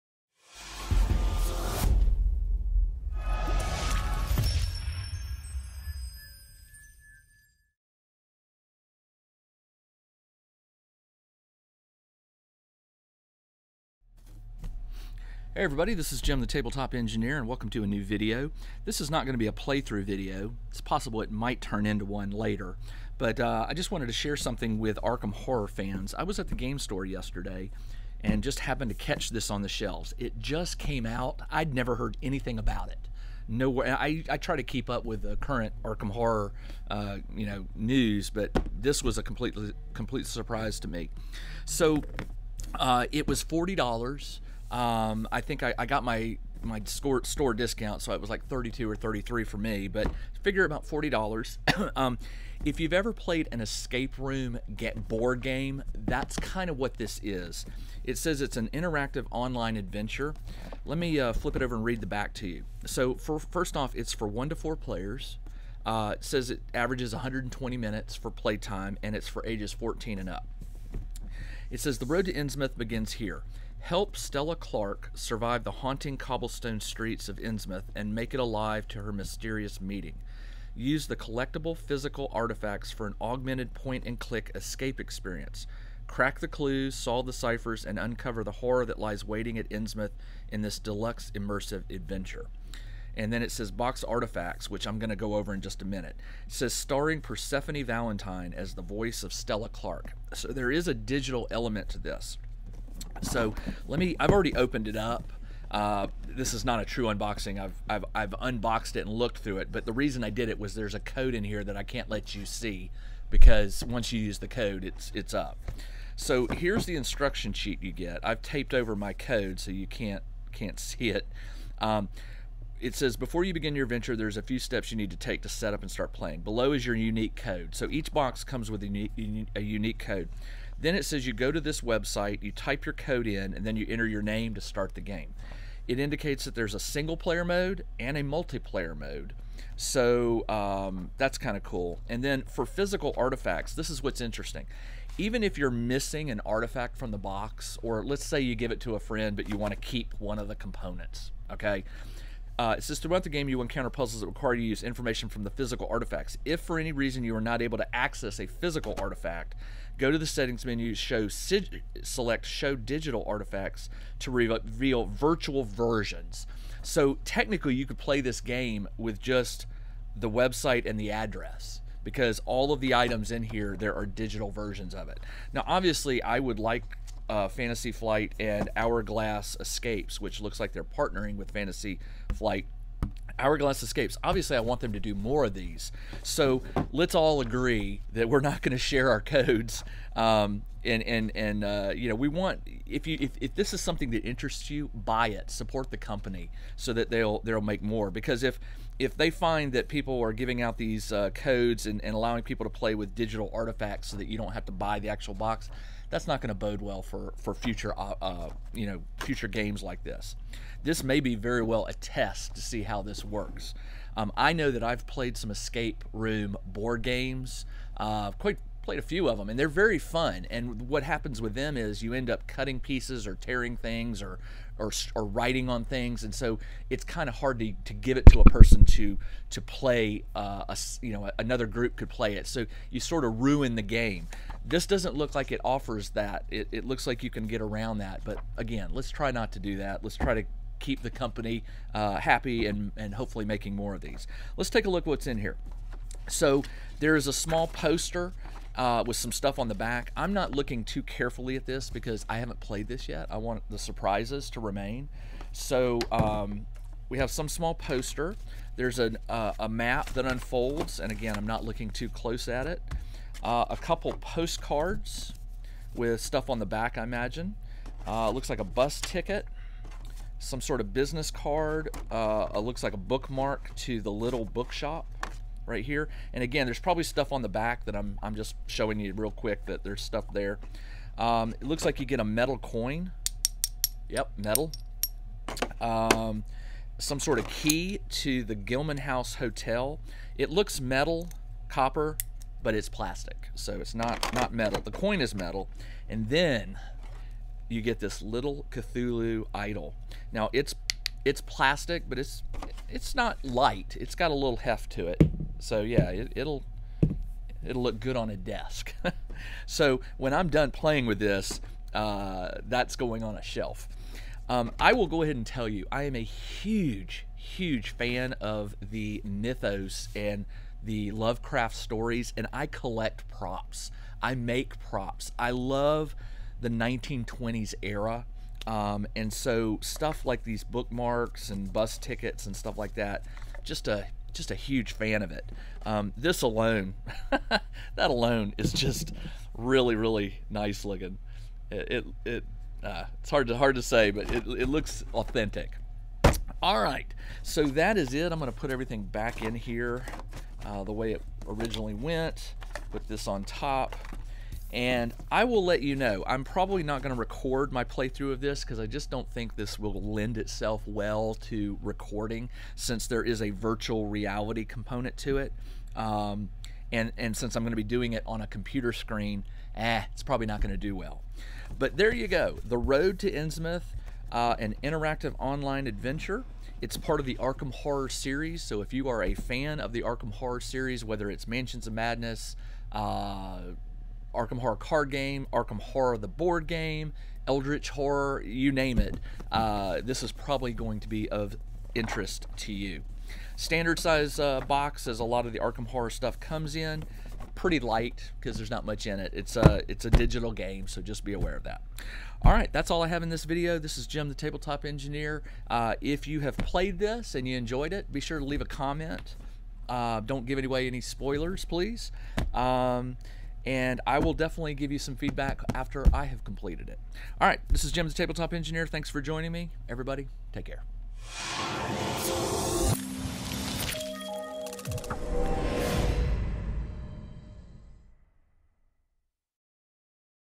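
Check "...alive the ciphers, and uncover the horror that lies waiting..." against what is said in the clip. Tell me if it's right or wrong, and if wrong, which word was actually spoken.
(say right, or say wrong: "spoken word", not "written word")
wrong: "solve", not "alive".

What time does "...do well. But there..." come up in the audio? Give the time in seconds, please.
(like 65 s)
370 s.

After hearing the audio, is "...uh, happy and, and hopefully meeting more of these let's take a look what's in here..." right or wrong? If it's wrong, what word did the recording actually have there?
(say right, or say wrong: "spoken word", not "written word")
wrong: "making", not "meeting".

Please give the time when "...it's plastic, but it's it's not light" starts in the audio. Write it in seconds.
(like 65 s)
301 s.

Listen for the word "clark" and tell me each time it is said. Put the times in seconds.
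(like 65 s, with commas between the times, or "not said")
74 s, 99 s.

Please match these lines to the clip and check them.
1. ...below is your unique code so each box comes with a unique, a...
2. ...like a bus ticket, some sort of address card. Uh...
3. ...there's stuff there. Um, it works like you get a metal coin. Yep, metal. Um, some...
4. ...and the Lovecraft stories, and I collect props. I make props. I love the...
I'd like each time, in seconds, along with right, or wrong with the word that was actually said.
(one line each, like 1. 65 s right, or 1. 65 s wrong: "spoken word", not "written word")
1. 126 s right
2. 268 s wrong: "business", not "address"
3. 279 s wrong: "looks", not "works"
4. 320 s right.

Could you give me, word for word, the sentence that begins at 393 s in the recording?
Standard size uh, box, as a lot of the Arkham Horror stuff comes in, pretty light because there's not much in it.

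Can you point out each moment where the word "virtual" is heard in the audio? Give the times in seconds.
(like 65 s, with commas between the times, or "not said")
165 s, 363 s.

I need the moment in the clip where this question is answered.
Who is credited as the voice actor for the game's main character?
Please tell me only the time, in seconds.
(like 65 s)
97 s.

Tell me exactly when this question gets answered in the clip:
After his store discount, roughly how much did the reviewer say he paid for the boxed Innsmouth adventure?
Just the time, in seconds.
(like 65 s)
48 s.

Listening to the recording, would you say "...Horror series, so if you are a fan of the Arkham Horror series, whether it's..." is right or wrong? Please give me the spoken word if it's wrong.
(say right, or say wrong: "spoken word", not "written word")
right.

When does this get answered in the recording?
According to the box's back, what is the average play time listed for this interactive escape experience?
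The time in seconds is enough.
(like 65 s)
67 s.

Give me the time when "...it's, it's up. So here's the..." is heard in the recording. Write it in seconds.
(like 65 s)
114 s.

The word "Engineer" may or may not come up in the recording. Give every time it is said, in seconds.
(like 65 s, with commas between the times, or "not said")
16 s, 404 s, 418 s.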